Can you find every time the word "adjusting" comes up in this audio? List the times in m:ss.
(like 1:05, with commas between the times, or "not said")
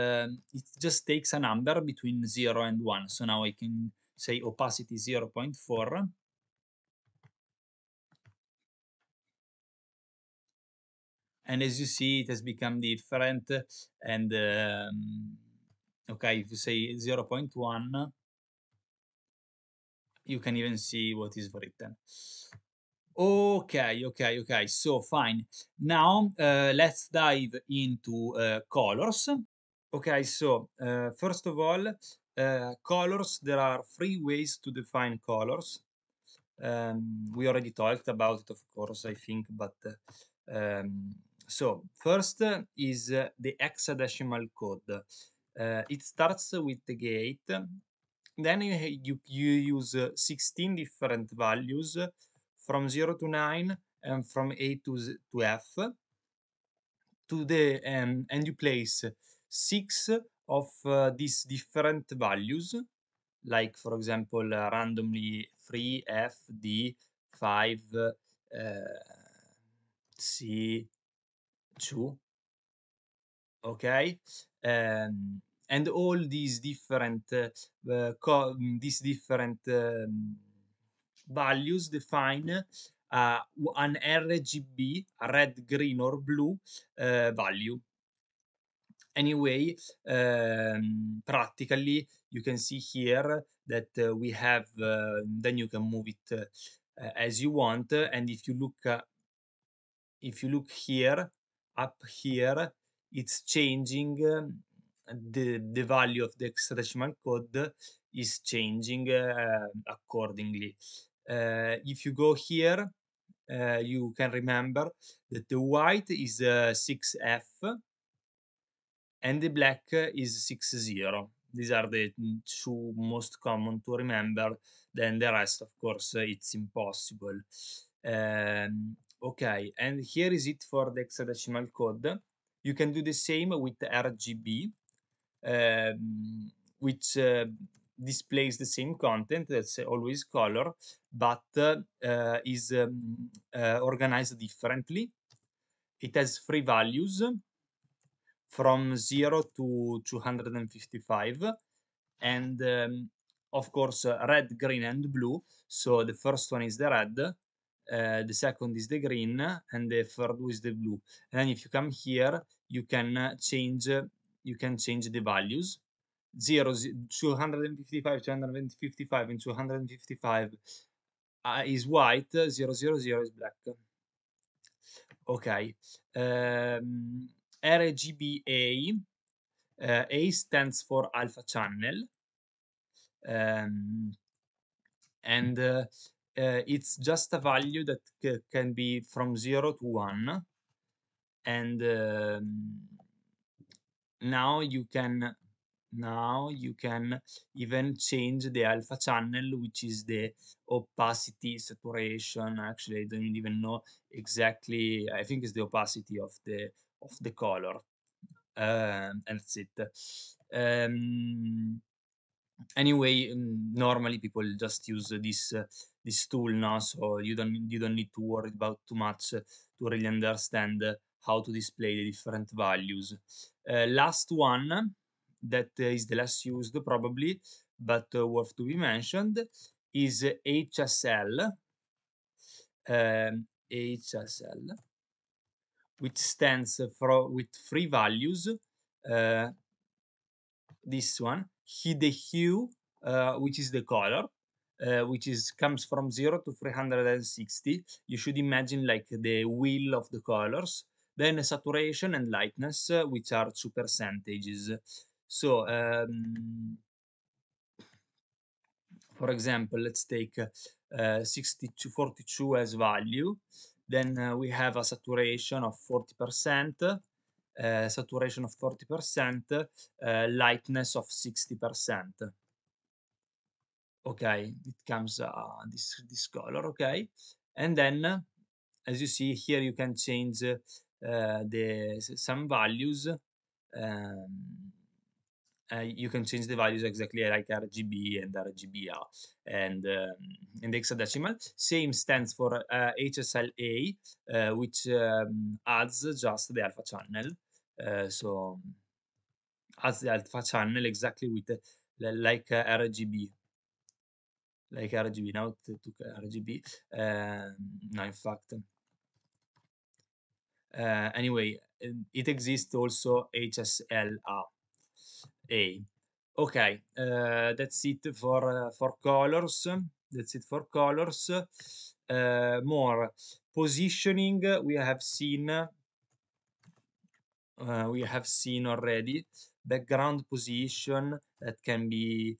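not said.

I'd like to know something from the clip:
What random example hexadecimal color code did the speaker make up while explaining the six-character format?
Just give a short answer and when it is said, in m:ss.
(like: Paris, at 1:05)
3fd5c2, at 1:05.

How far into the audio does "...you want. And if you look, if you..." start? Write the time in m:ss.
1:37.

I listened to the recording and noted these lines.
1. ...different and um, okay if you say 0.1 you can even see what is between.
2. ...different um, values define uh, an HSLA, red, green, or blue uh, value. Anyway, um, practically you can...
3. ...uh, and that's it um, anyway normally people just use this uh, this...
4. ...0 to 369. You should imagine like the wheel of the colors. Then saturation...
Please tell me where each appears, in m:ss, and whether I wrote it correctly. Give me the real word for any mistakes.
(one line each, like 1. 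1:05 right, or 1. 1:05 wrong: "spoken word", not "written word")
1. 0:12 wrong: "written", not "between"
2. 1:19 wrong: "RGB", not "HSLA"
3. 3:28 right
4. 4:06 wrong: "360", not "369".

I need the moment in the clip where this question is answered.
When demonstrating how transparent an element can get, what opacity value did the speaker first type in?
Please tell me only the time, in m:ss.
0:04.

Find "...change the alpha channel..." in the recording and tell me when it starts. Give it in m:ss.
3:17.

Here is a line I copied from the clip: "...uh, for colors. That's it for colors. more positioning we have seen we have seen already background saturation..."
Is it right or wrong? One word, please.
wrong.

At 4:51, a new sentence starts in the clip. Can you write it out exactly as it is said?
Same stands for uh, HSLA, uh, which um, adds just the alpha channel.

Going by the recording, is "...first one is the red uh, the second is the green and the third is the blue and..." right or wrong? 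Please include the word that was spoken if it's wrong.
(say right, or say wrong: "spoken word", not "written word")
right.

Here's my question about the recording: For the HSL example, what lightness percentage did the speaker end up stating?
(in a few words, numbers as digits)
60%.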